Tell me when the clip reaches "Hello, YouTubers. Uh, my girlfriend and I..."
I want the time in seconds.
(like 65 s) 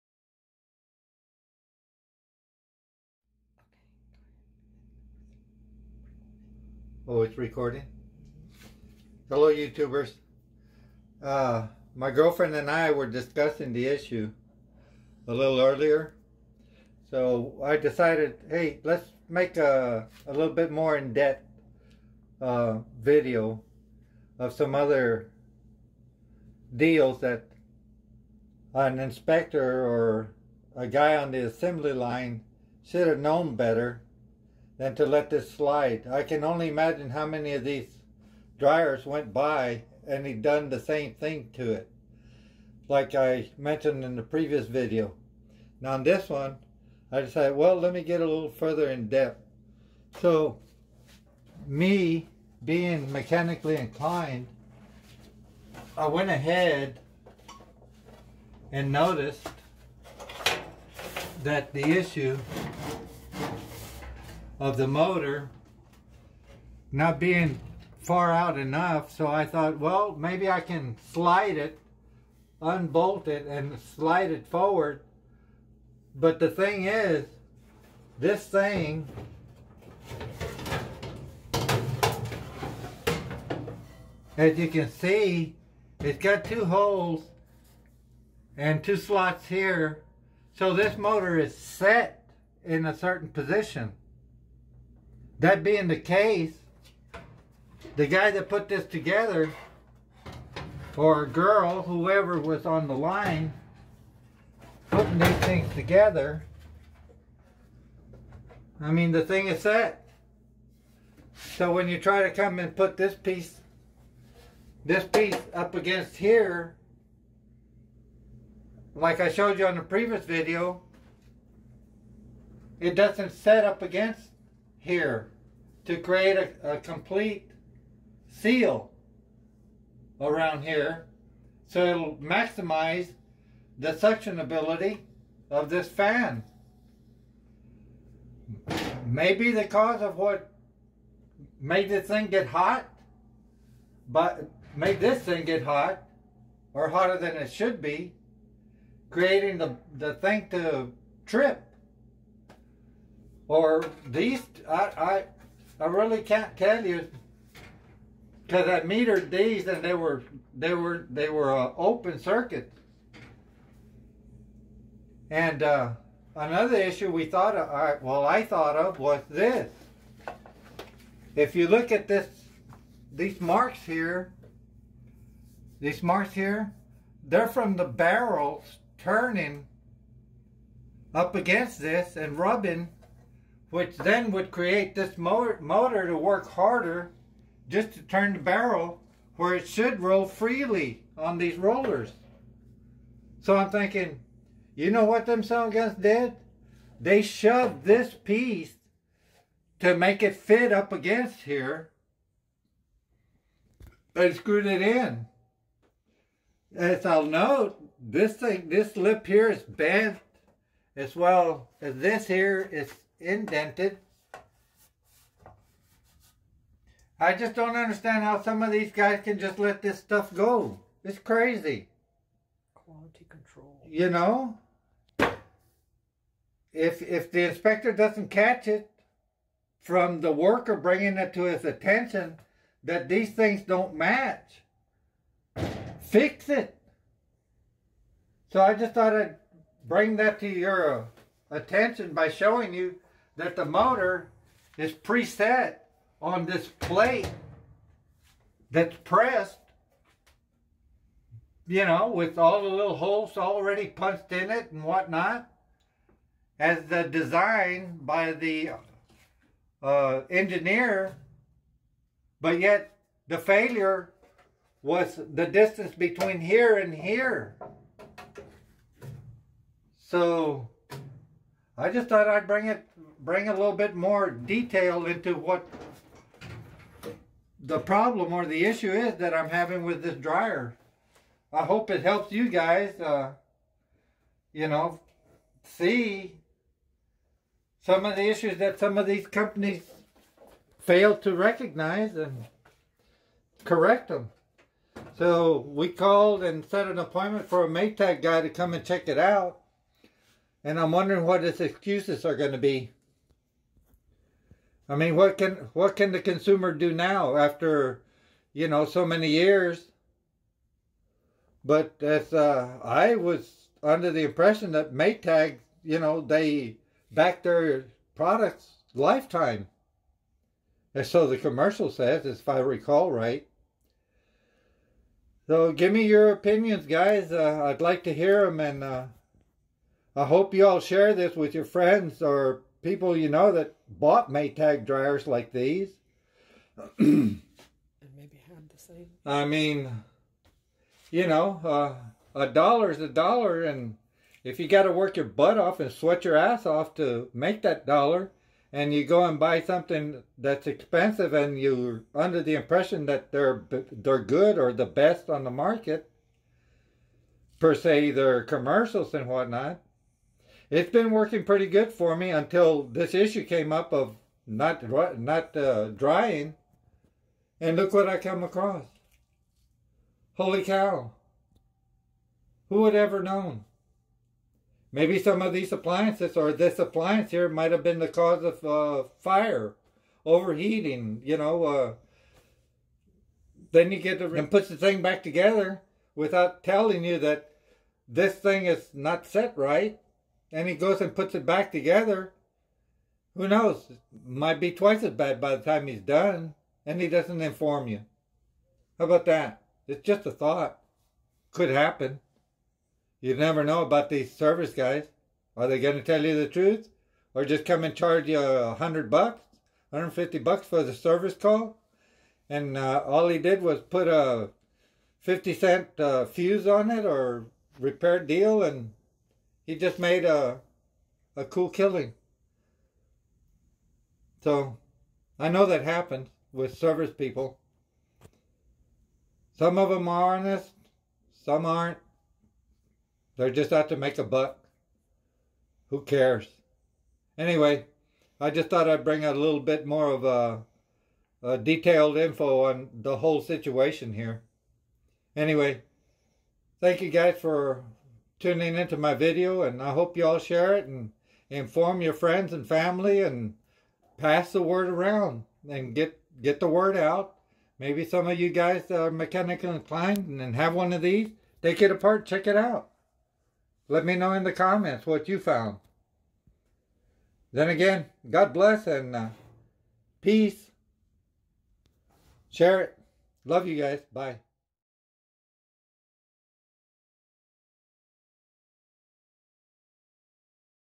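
9 s.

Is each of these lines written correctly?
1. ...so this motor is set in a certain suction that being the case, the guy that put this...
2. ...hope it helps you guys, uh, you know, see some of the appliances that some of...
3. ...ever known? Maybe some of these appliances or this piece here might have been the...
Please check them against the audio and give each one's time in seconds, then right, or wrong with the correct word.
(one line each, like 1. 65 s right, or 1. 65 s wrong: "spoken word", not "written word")
1. 90 s wrong: "position", not "suction"
2. 281 s wrong: "issues", not "appliances"
3. 372 s wrong: "appliance", not "piece".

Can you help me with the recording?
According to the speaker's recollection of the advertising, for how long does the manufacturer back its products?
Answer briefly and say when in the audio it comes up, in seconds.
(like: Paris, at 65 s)
lifetime, at 318 s.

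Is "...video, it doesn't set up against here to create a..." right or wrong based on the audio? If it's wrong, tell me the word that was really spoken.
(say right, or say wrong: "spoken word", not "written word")
right.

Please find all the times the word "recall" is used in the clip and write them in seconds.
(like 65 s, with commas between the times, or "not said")
322 s.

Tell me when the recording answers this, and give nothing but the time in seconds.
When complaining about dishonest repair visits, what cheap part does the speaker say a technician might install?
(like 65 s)
415 s.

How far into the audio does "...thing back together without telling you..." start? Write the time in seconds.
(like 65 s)
384 s.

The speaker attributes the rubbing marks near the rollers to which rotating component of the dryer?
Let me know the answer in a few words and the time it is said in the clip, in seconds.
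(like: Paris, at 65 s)
the barrels, at 177 s.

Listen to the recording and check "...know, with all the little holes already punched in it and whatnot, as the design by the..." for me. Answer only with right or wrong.
right.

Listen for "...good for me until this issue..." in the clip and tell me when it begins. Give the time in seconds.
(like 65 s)
361 s.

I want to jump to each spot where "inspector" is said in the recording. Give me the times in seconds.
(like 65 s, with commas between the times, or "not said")
28 s, 227 s.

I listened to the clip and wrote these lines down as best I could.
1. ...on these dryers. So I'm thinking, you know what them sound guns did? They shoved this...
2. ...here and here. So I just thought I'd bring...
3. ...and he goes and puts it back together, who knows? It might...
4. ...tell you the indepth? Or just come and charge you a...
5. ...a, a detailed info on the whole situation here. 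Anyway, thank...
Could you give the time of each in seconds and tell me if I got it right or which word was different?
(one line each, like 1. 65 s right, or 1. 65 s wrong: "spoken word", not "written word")
1. 191 s wrong: "rollers", not "dryers"
2. 266 s right
3. 390 s right
4. 406 s wrong: "truth", not "indepth"
5. 440 s right.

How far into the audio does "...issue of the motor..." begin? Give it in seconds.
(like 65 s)
61 s.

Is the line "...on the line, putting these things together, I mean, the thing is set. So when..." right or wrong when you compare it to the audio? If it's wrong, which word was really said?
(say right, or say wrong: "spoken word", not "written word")
right.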